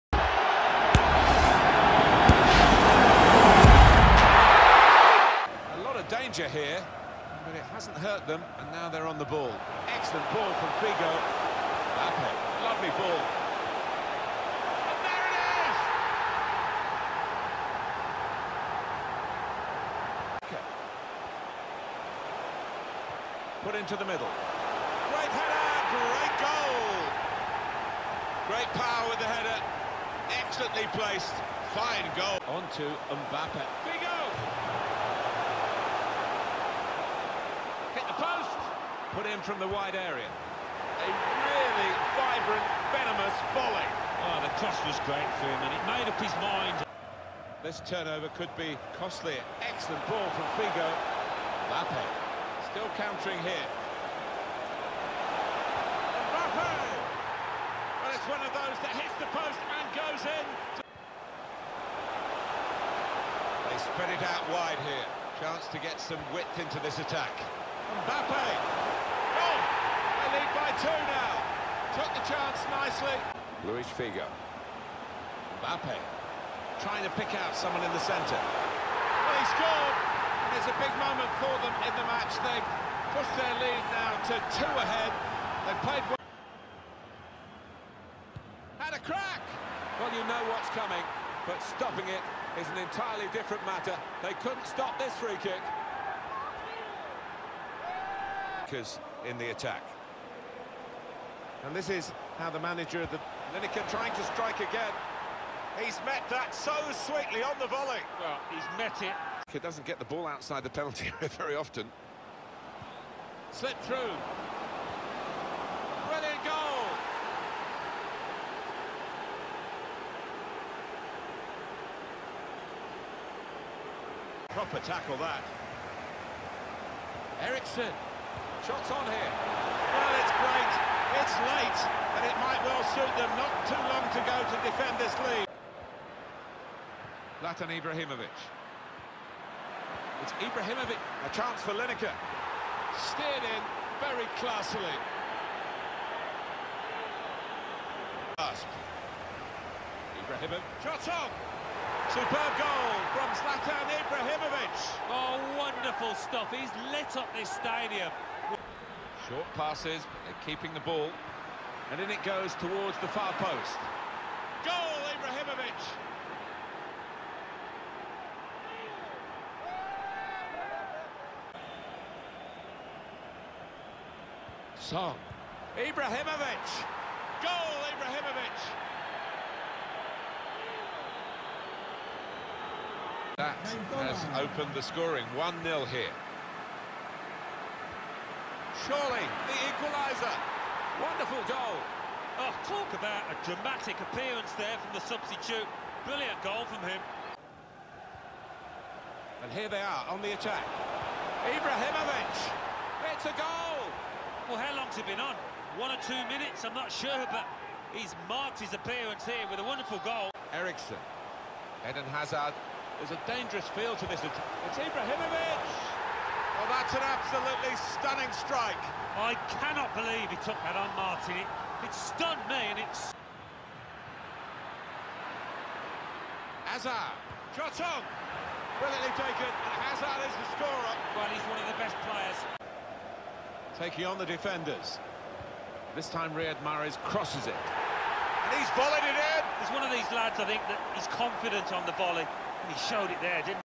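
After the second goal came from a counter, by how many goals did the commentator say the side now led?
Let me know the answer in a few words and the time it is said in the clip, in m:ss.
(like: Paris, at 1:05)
2, at 1:24.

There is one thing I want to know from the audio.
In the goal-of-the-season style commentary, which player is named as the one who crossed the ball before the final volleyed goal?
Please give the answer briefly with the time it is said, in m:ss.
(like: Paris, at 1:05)
Riyad Mahrez, at 3:56.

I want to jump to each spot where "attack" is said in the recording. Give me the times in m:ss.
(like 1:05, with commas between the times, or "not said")
1:06, 1:39, 3:20.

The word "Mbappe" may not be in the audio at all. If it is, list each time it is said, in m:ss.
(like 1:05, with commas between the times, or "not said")
0:33, 0:51, 0:56, 1:08, 1:15.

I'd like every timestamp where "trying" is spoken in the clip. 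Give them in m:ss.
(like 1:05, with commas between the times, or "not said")
1:16, 1:43.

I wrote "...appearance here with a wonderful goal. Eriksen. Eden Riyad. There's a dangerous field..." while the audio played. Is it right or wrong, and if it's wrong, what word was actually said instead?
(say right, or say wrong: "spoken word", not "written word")
wrong: "Hazard", not "Riyad".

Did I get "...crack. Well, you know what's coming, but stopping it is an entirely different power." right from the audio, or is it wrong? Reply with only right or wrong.
wrong.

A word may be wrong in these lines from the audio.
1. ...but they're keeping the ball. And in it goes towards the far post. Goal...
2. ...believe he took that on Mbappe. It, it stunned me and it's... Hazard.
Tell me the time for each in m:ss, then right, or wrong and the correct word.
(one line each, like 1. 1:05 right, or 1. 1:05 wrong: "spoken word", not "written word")
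1. 2:40 right
2. 3:39 wrong: "Martin", not "Mbappe".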